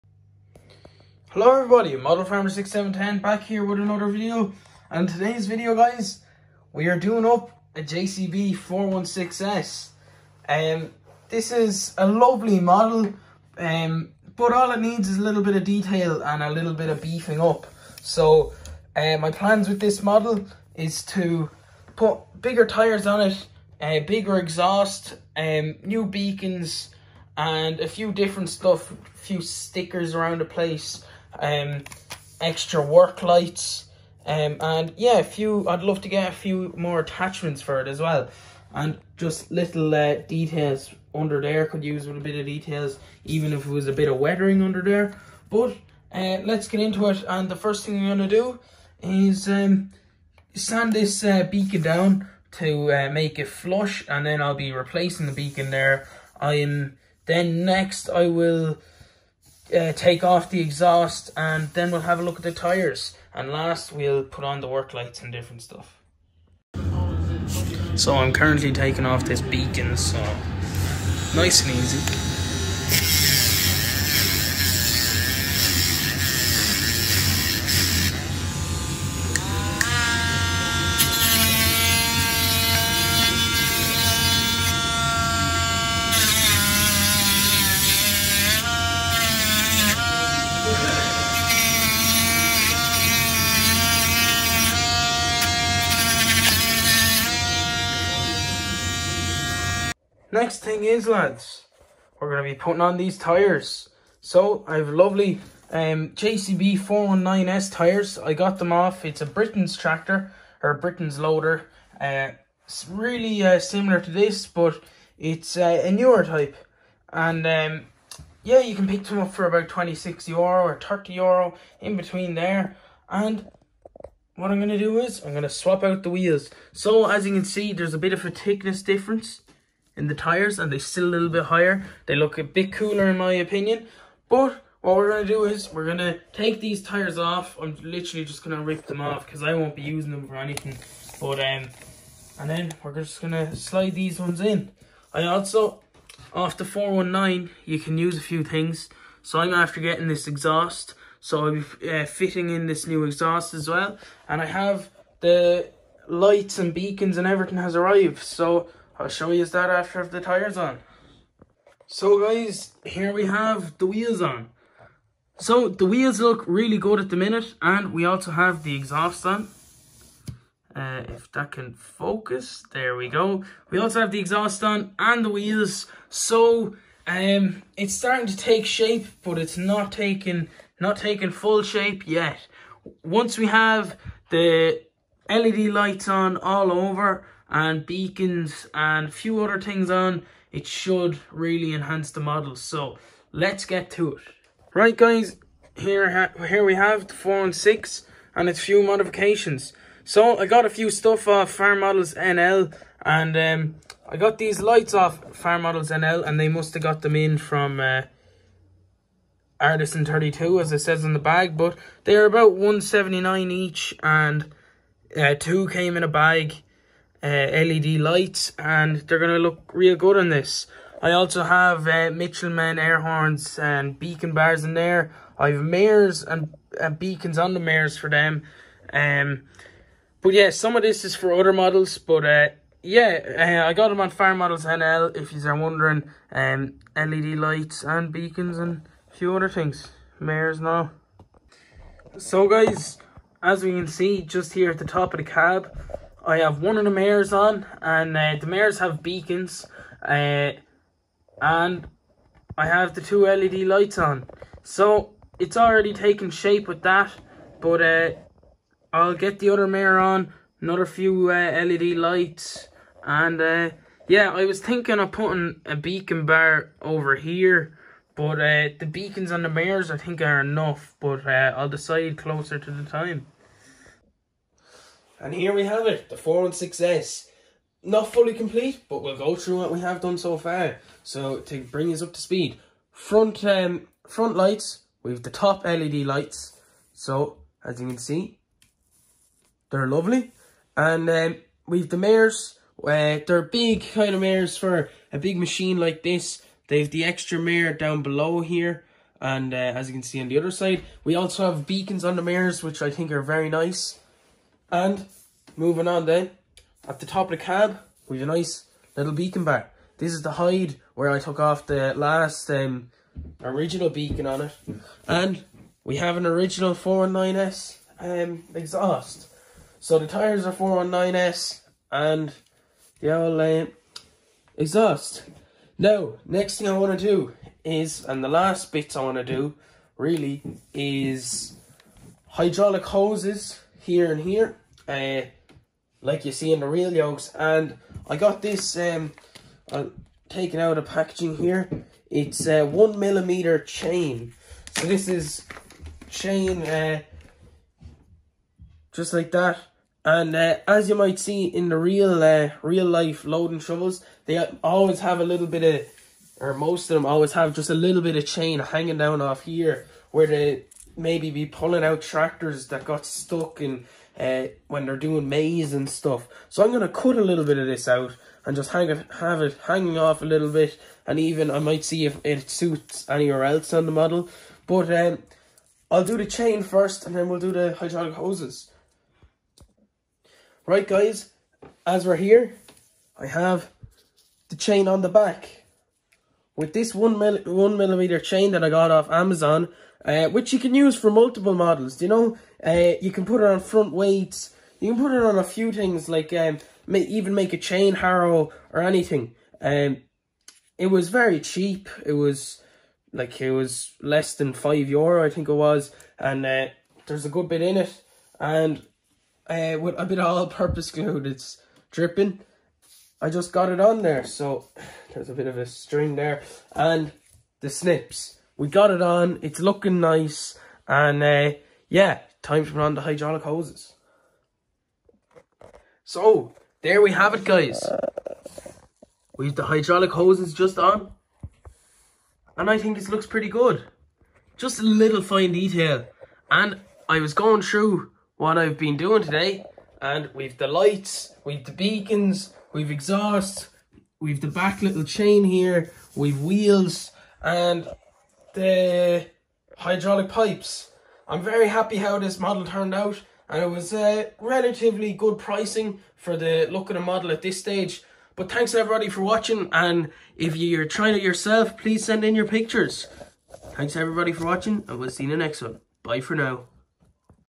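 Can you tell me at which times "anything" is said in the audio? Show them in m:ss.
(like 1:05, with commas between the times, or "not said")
2:20, 6:38.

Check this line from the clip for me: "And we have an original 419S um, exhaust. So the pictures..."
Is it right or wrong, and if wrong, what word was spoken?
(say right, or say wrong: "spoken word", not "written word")
wrong: "tyres", not "pictures".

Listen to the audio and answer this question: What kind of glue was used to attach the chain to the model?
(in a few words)
All-purpose glue.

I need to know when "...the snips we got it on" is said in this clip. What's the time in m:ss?
6:57.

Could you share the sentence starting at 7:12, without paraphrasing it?
And I think it looks pretty good.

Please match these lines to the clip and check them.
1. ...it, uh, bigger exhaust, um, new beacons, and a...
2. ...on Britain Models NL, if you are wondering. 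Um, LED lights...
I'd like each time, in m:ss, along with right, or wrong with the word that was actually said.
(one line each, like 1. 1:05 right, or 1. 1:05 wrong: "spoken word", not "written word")
1. 0:23 right
2. 3:54 wrong: "Farm", not "Britain".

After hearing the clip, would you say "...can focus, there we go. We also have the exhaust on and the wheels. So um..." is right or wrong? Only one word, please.
right.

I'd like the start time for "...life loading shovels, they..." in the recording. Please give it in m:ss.
5:52.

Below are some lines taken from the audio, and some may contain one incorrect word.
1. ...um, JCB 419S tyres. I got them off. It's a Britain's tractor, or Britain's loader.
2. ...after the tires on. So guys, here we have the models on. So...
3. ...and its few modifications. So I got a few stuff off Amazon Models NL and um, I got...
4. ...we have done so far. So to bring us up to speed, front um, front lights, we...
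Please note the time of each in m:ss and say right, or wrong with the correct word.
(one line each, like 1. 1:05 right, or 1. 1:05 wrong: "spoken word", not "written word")
1. 1:45 right
2. 2:39 wrong: "wheels", not "models"
3. 3:18 wrong: "Farm", not "Amazon"
4. 4:39 right.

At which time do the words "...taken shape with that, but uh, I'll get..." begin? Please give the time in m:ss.
4:15.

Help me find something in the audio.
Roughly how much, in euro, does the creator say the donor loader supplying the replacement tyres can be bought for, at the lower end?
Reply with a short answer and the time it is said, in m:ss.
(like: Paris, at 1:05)
26 euro, at 1:59.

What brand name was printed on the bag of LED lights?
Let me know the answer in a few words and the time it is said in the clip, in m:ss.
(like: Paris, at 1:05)
Artisan 32, at 3:29.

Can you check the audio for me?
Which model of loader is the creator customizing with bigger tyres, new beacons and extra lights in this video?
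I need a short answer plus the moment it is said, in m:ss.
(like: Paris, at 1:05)
JCB 416S, at 0:07.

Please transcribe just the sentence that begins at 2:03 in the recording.
And what I'm going to do is I'm going to swap out the wheels.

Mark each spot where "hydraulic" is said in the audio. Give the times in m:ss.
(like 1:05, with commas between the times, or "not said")
5:32, 6:17, 7:03, 7:09, 7:29.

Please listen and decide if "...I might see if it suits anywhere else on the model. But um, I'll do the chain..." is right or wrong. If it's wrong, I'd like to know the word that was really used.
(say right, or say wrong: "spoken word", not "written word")
right.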